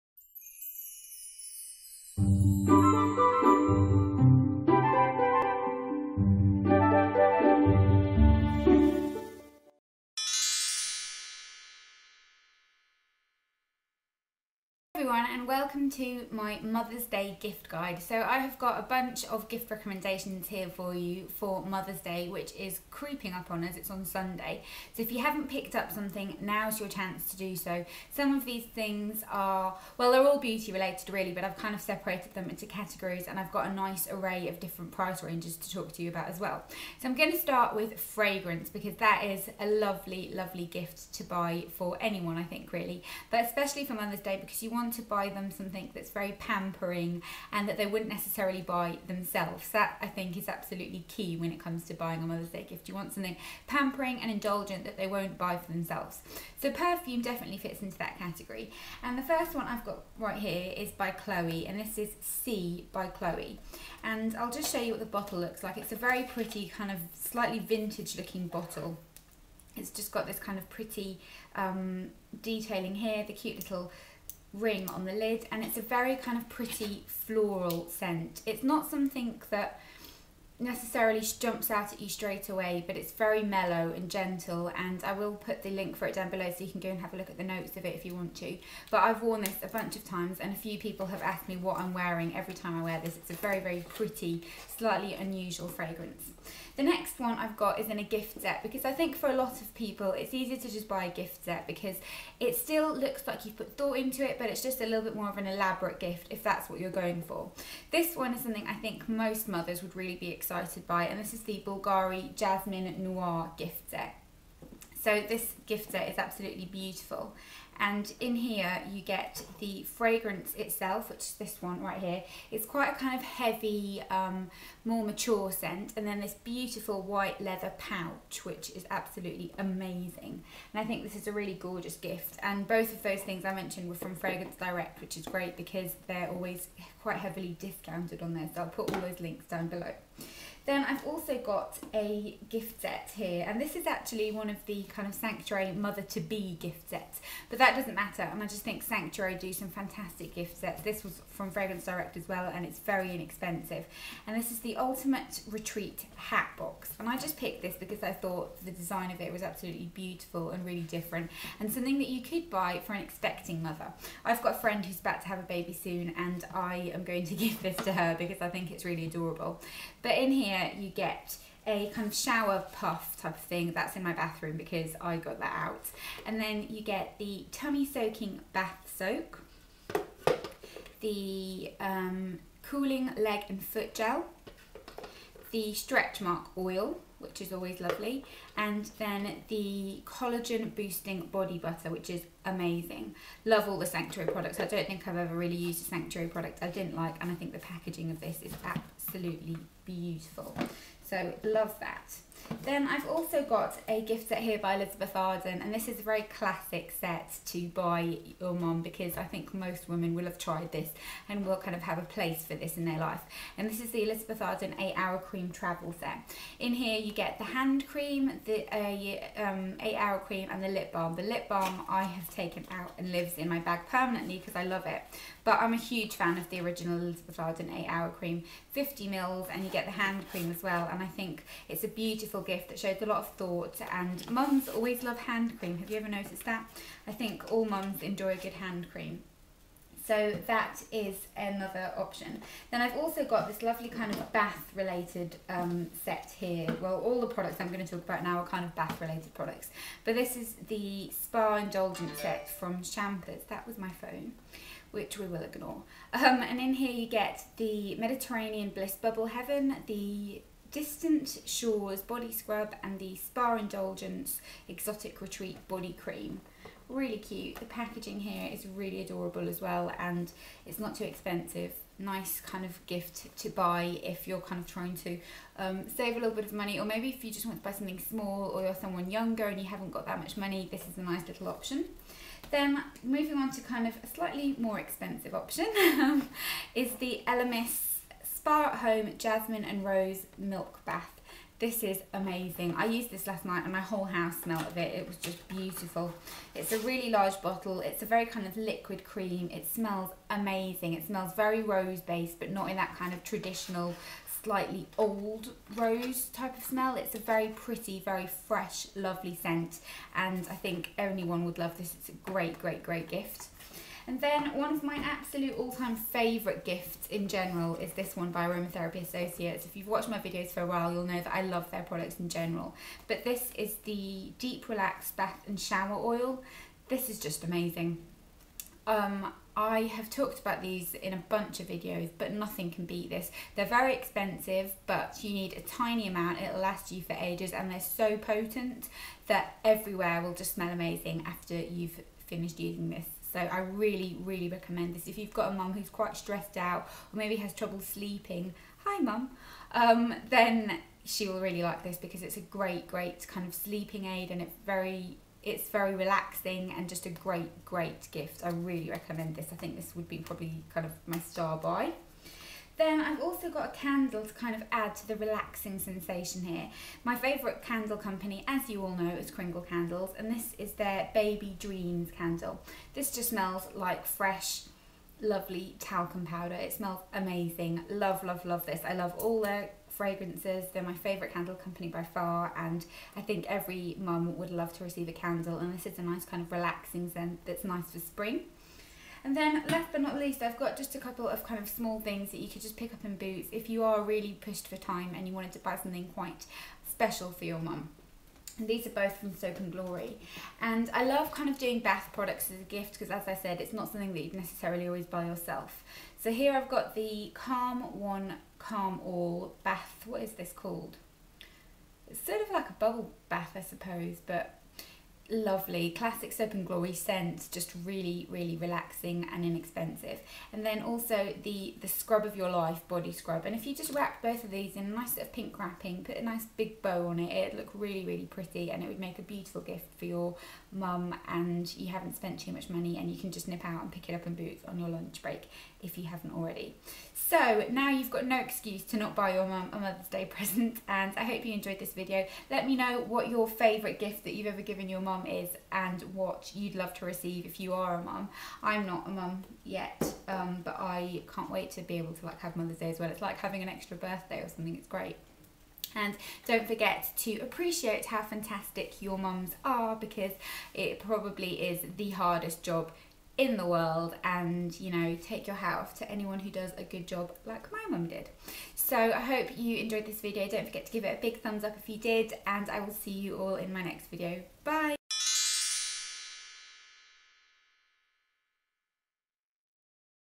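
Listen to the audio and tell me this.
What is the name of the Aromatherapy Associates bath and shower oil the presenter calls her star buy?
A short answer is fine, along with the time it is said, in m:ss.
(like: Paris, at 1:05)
Deep Relax, at 5:24.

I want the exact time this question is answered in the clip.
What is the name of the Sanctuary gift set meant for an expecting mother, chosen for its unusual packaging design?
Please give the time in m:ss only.
2:34.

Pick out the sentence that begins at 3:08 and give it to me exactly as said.
And then the collagen boosting body butter, which is amazing.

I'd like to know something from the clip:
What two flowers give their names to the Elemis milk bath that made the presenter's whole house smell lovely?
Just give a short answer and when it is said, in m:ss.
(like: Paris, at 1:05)
Jasmine and Rose, at 4:49.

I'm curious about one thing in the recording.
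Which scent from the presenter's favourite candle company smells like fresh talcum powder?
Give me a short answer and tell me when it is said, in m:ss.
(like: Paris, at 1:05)
Baby Dreams, at 6:11.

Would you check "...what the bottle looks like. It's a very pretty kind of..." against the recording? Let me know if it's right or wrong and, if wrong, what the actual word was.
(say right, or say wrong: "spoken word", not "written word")
right.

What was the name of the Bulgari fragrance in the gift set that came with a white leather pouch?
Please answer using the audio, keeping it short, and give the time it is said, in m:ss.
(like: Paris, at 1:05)
Jasmine Noir, at 1:52.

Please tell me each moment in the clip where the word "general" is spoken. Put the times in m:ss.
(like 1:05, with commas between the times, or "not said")
5:17, 5:22.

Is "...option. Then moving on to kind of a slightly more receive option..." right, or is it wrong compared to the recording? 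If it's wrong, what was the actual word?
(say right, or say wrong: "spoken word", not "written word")
wrong: "expensive", not "receive".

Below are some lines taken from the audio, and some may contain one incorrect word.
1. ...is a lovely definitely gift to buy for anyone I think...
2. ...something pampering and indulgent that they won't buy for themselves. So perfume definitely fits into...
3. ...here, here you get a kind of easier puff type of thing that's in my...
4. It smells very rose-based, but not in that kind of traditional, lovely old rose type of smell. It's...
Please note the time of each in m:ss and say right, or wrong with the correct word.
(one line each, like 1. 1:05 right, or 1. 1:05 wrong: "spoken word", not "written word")
1. 0:39 wrong: "lovely", not "definitely"
2. 0:53 right
3. 2:50 wrong: "shower", not "easier"
4. 5:00 wrong: "slightly", not "lovely".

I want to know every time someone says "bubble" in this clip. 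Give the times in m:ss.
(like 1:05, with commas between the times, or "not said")
4:19, 6:52.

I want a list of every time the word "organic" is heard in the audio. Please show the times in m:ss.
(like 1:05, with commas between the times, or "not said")
not said.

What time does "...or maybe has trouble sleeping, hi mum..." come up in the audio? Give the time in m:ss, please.
5:47.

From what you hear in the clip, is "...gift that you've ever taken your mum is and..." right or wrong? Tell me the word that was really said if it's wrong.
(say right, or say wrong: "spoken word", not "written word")
wrong: "given", not "taken".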